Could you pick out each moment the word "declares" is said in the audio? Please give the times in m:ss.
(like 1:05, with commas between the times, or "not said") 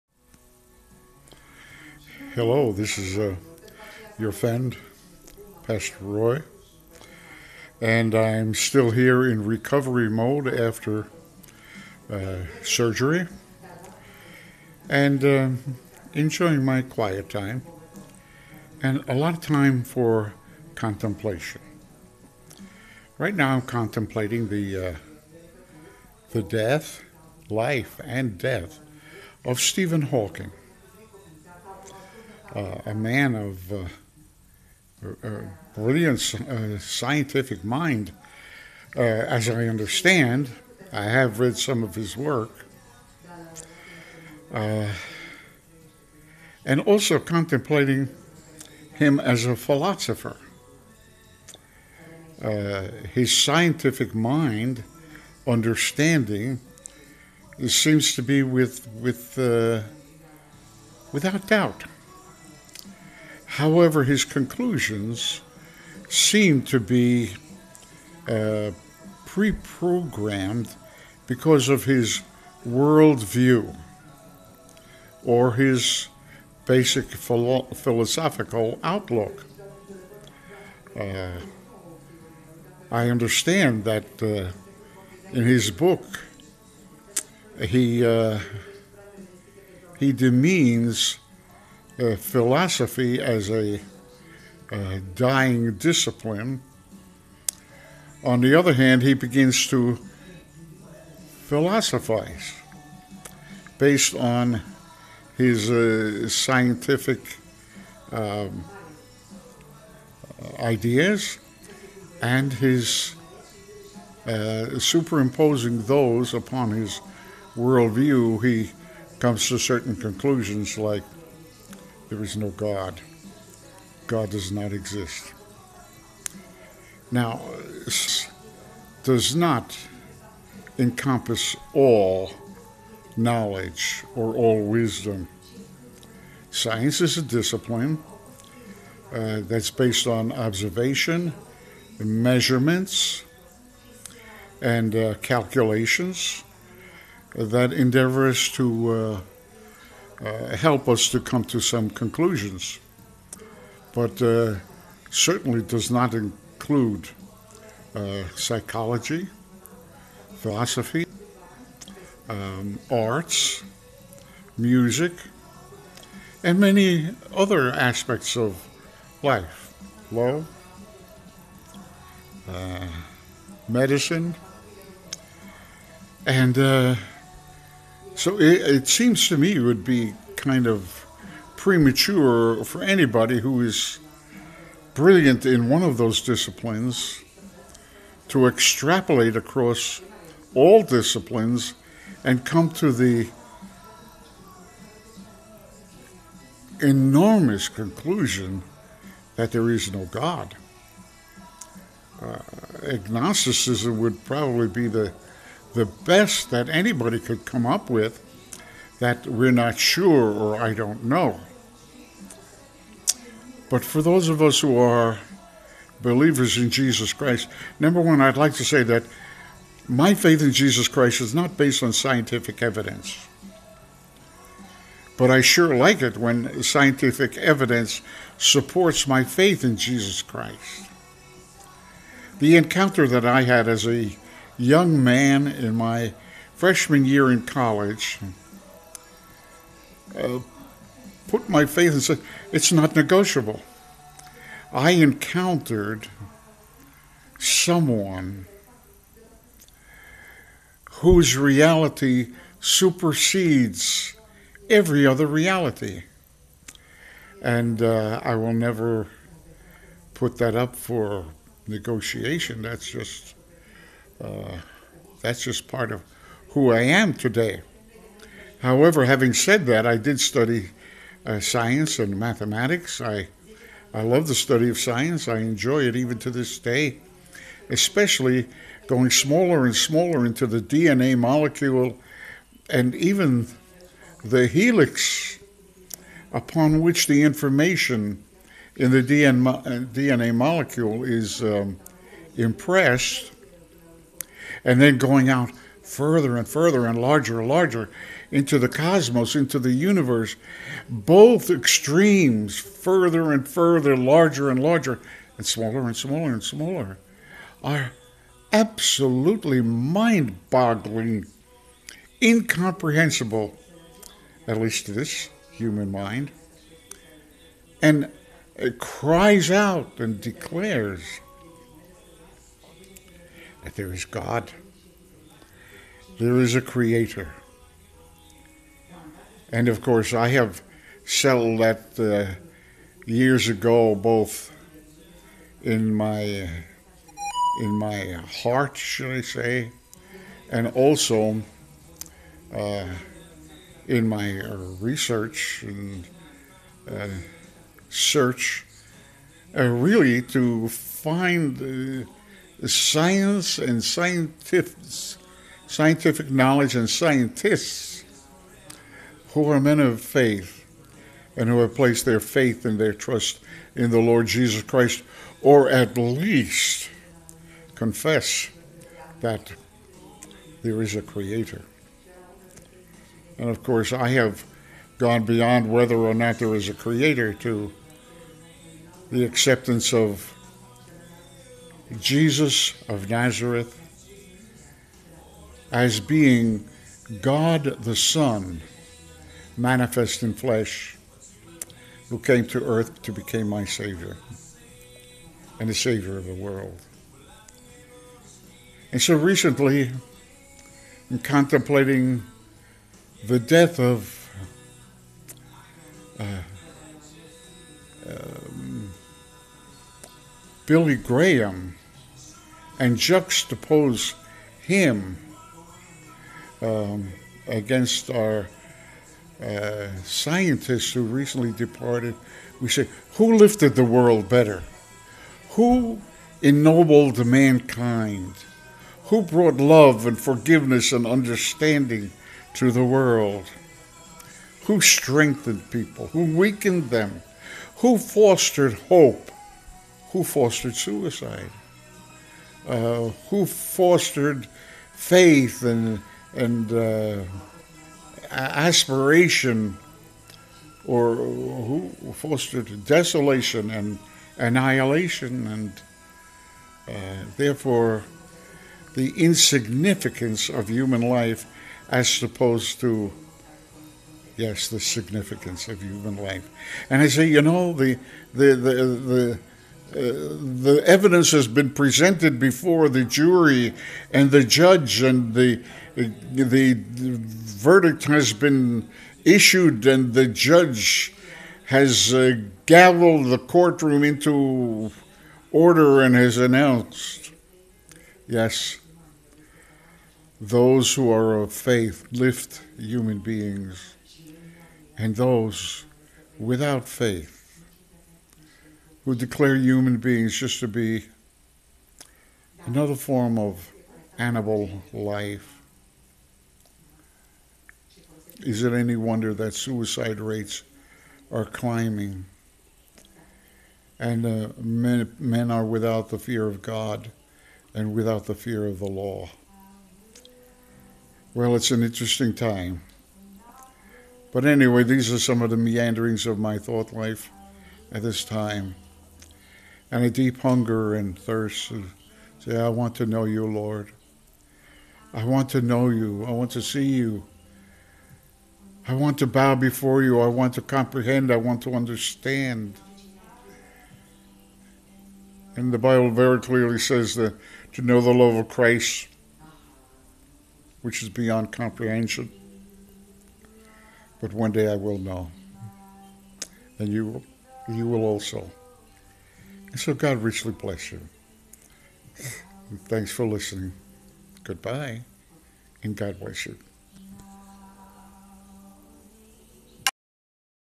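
5:20, 8:19.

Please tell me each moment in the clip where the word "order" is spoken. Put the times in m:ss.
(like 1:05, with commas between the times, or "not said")
8:05.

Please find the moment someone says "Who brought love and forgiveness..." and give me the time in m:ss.
7:09.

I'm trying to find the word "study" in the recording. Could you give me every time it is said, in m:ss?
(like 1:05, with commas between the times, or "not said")
4:30, 4:34.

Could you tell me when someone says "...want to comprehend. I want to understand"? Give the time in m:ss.
9:00.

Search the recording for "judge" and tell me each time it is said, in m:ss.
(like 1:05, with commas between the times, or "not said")
7:54, 8:00.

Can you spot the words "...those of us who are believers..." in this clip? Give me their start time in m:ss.
3:34.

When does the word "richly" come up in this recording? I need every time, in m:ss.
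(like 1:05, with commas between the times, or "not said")
9:20.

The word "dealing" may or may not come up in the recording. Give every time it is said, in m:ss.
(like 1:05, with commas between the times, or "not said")
not said.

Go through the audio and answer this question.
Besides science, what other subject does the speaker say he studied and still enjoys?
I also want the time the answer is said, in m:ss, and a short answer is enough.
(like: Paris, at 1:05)
mathematics, at 4:32.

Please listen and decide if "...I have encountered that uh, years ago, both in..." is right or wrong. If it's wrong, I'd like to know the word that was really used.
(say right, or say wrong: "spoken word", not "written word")
wrong: "settled", not "encountered".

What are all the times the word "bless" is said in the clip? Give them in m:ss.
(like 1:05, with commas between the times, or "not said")
9:20, 9:26.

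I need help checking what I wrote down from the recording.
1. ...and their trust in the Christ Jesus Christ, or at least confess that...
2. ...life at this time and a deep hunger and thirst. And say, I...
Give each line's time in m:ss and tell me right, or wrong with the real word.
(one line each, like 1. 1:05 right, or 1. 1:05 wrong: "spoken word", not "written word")
1. 6:02 wrong: "Lord", not "Christ"
2. 8:46 right.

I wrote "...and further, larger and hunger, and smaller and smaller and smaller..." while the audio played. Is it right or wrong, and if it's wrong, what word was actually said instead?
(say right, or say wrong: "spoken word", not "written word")
wrong: "larger", not "hunger".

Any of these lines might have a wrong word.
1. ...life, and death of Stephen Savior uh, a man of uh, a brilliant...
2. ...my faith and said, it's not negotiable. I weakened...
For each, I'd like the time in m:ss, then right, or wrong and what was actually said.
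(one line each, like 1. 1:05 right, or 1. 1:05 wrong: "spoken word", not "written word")
1. 0:27 wrong: "Hawking", not "Savior"
2. 4:01 wrong: "encountered", not "weakened".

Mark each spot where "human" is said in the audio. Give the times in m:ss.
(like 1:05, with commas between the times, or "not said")
5:15, 7:40, 7:45, 8:12, 8:19.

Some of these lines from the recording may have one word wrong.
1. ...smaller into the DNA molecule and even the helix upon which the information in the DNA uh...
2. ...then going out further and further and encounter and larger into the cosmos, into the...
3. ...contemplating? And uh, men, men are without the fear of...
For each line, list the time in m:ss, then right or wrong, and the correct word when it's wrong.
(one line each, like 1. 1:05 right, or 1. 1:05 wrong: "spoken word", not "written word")
1. 4:39 right
2. 4:54 wrong: "larger", not "encounter"
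3. 8:31 wrong: "climbing", not "contemplating".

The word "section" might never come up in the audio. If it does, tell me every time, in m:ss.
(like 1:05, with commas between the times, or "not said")
not said.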